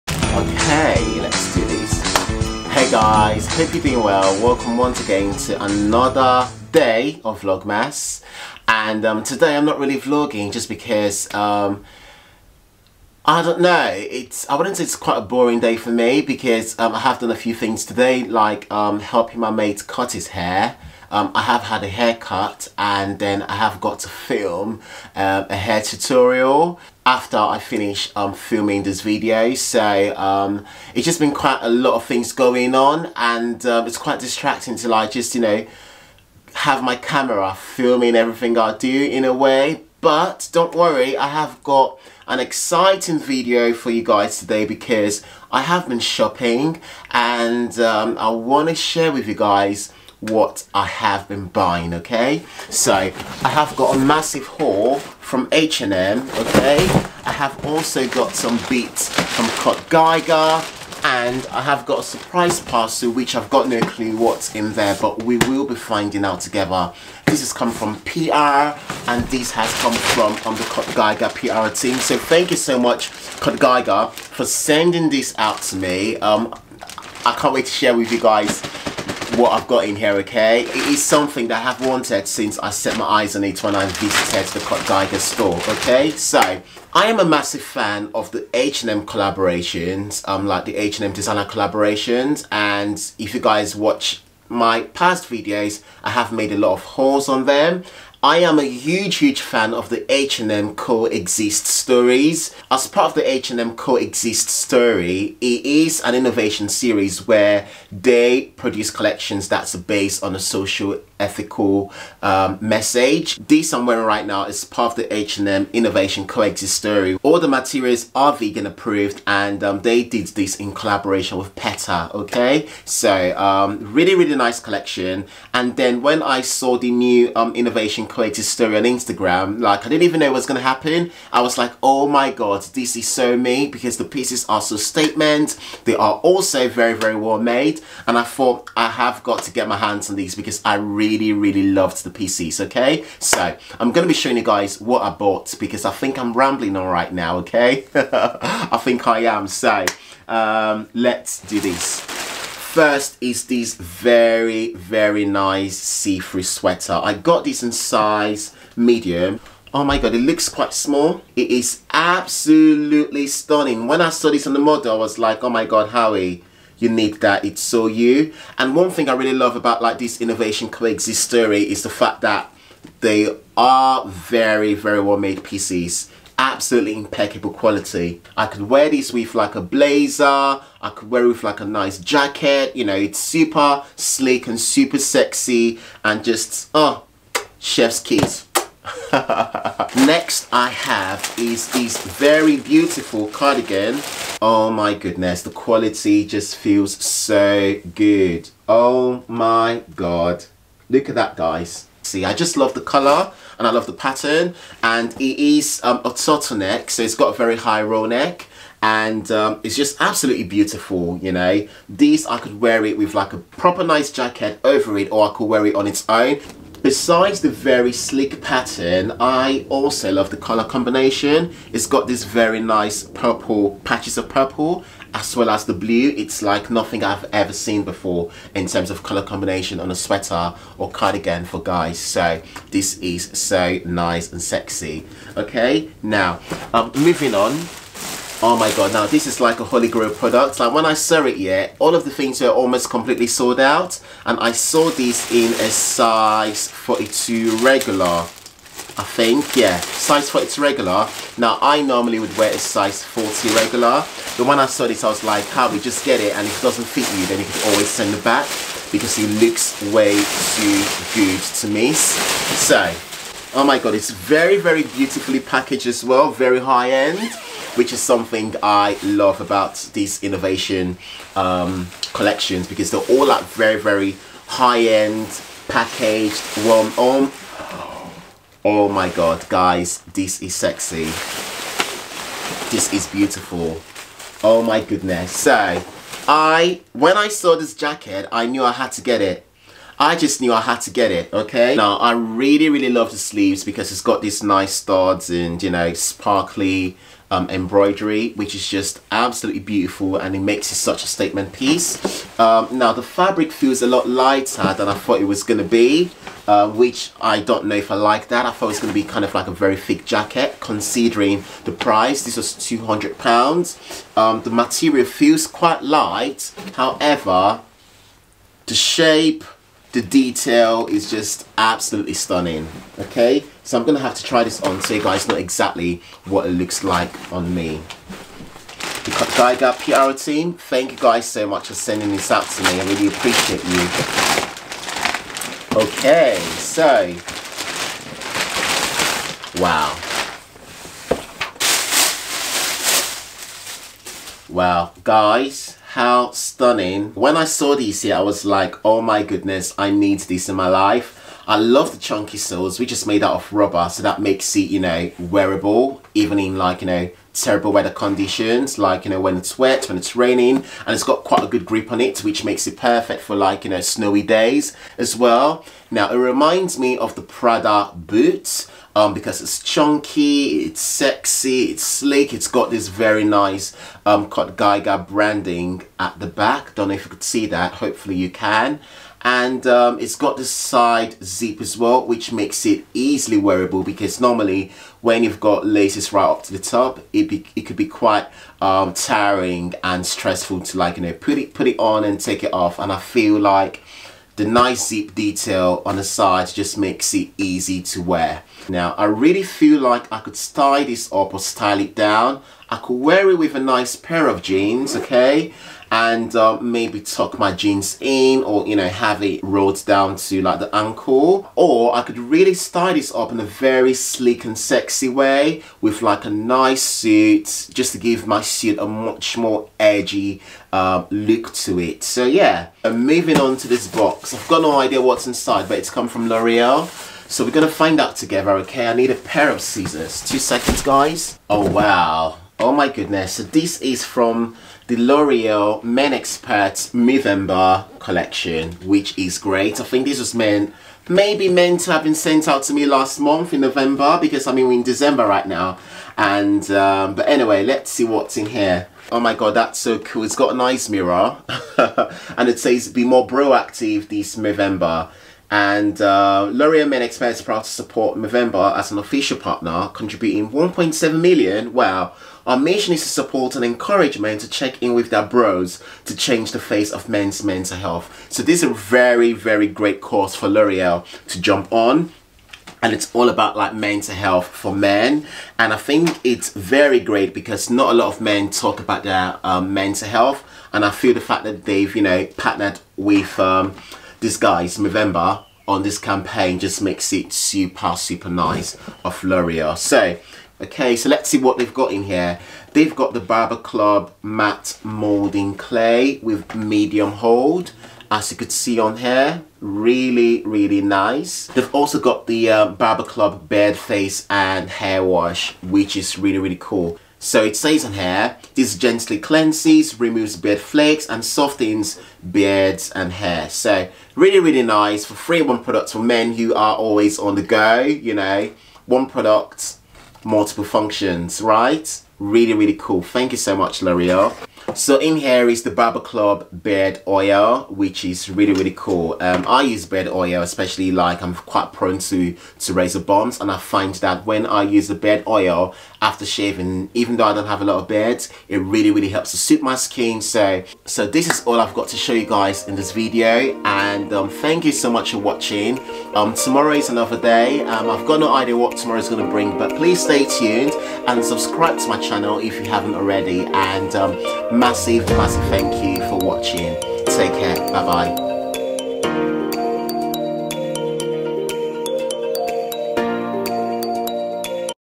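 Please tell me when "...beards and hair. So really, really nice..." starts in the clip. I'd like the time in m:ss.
8:32.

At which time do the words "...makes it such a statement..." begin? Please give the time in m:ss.
5:00.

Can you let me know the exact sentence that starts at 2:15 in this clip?
They are also very, very well made.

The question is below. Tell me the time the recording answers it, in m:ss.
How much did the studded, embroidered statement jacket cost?
5:12.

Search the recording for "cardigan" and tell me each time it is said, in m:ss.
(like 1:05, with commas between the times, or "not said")
3:13, 3:50.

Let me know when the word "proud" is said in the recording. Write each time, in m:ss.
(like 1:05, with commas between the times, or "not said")
7:37.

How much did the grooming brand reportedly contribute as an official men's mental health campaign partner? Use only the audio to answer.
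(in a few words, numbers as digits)
1.7 million.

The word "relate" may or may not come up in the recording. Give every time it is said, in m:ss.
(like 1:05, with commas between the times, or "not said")
not said.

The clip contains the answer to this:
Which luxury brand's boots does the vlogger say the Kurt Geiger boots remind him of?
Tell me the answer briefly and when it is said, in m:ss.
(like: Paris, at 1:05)
Prada, at 6:07.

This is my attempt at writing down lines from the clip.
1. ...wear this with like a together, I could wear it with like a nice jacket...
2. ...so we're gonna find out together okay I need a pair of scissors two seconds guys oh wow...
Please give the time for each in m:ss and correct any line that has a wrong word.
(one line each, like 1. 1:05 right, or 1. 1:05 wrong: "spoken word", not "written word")
1. 2:58 wrong: "blazer", not "together"
2. 7:07 right.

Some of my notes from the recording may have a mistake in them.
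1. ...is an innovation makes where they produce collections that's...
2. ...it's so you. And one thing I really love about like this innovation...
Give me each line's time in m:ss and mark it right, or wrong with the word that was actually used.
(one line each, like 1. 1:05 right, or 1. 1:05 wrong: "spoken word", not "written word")
1. 1:45 wrong: "series", not "makes"
2. 2:47 right.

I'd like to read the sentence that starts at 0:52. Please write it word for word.
So, I have got a massive haul from H&M, okay?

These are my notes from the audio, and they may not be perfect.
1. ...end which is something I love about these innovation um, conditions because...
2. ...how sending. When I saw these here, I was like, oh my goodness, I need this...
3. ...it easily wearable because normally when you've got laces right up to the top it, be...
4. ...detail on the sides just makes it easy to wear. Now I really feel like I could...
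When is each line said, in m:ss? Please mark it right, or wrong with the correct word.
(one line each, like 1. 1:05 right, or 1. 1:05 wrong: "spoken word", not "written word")
1. 4:26 wrong: "collections", not "conditions"
2. 5:45 wrong: "stunning", not "sending"
3. 6:22 right
4. 6:35 right.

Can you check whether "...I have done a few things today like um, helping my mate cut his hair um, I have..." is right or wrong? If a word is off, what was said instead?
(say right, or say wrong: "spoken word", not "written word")
right.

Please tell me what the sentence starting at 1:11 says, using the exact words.
So thank you so much Kurt Geiger for sending this out to me.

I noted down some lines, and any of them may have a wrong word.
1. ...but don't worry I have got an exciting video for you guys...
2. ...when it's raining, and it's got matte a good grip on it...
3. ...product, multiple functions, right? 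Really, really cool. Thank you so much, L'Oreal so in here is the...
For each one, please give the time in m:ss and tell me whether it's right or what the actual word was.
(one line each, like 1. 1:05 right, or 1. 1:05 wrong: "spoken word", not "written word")
1. 0:39 right
2. 5:59 wrong: "quite", not "matte"
3. 8:39 right.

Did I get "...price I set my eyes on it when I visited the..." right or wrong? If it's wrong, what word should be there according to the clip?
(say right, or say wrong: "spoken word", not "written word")
wrong: "since", not "price".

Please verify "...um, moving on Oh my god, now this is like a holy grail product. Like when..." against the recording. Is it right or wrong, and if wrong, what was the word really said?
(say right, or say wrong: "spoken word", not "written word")
right.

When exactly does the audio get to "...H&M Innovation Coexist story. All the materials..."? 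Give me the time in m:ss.
1:55.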